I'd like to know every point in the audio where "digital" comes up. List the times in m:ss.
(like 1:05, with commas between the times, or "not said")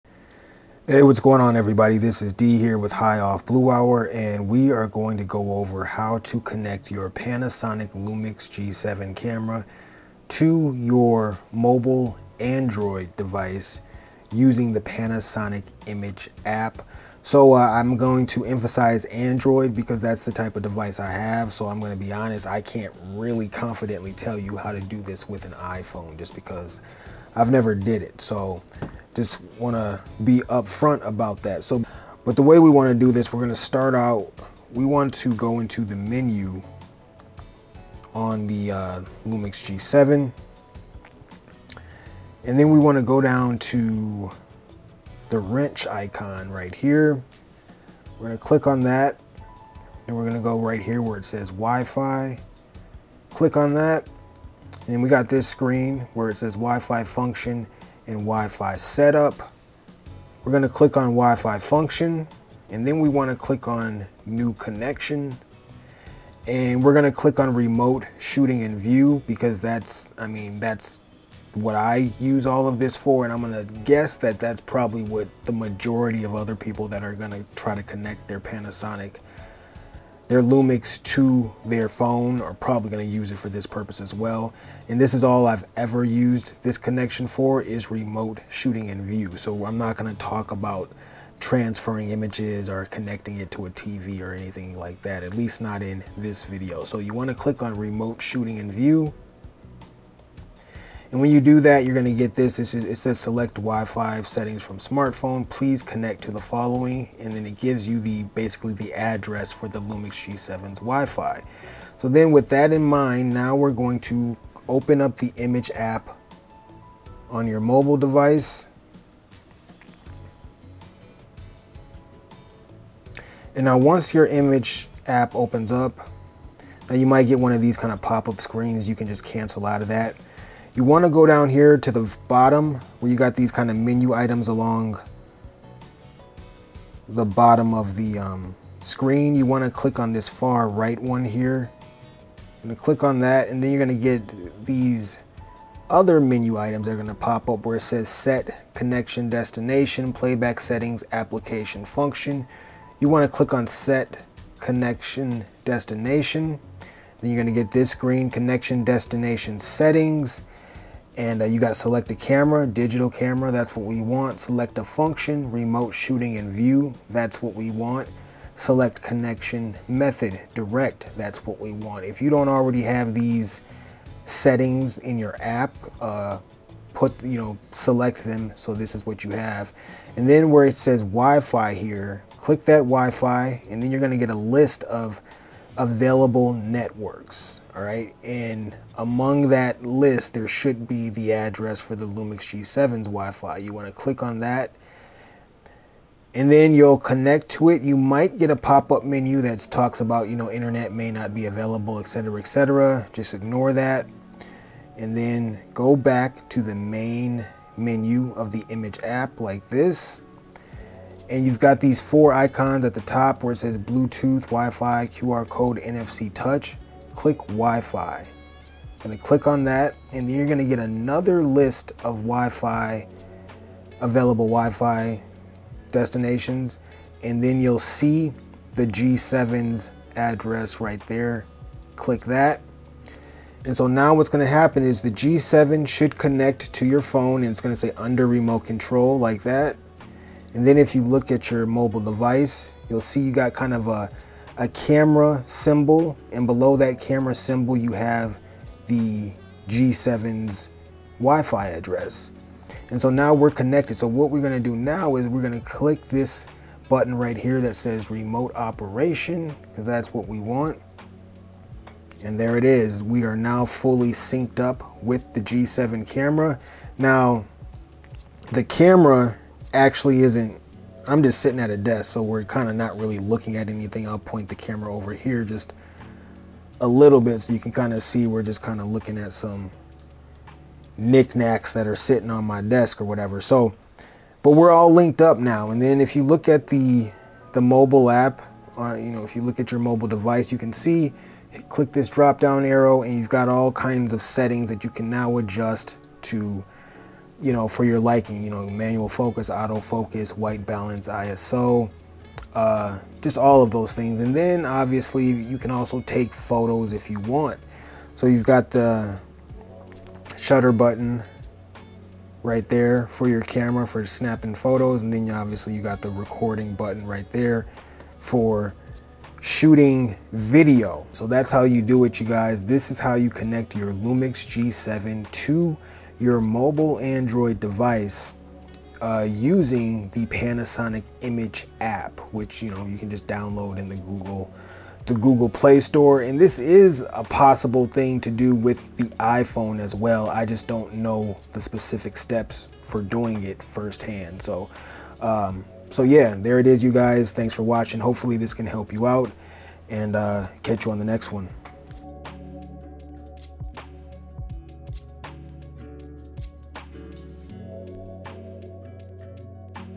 2:42.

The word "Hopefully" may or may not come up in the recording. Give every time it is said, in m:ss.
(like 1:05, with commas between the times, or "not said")
5:47.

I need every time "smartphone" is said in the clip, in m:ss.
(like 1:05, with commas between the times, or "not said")
1:44.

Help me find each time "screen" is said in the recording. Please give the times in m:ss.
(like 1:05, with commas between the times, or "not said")
0:55, 2:08, 2:18.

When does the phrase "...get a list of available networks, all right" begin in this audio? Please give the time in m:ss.
3:04.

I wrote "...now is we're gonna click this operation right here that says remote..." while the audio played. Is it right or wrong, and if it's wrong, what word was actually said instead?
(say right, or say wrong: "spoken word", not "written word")
wrong: "button", not "operation".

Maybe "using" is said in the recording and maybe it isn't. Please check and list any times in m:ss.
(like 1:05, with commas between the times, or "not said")
0:14, 5:29.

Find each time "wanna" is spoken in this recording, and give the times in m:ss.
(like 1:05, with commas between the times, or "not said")
1:03, 1:37, 3:13.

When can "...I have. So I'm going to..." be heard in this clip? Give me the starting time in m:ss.
0:20.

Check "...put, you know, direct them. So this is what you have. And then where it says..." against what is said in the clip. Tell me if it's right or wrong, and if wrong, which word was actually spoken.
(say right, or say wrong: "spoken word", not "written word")
wrong: "select", not "direct".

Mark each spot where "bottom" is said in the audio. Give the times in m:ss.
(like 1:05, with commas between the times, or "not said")
2:12, 2:17.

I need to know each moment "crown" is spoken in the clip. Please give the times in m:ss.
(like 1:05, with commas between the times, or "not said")
not said.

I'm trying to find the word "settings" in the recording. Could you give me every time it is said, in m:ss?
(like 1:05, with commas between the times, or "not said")
1:44, 2:30, 2:39, 2:54, 4:54.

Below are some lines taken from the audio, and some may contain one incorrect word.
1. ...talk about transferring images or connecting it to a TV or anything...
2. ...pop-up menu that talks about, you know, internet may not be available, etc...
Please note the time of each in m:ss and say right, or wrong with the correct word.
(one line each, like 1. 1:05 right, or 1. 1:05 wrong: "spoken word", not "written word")
1. 1:30 right
2. 3:18 right.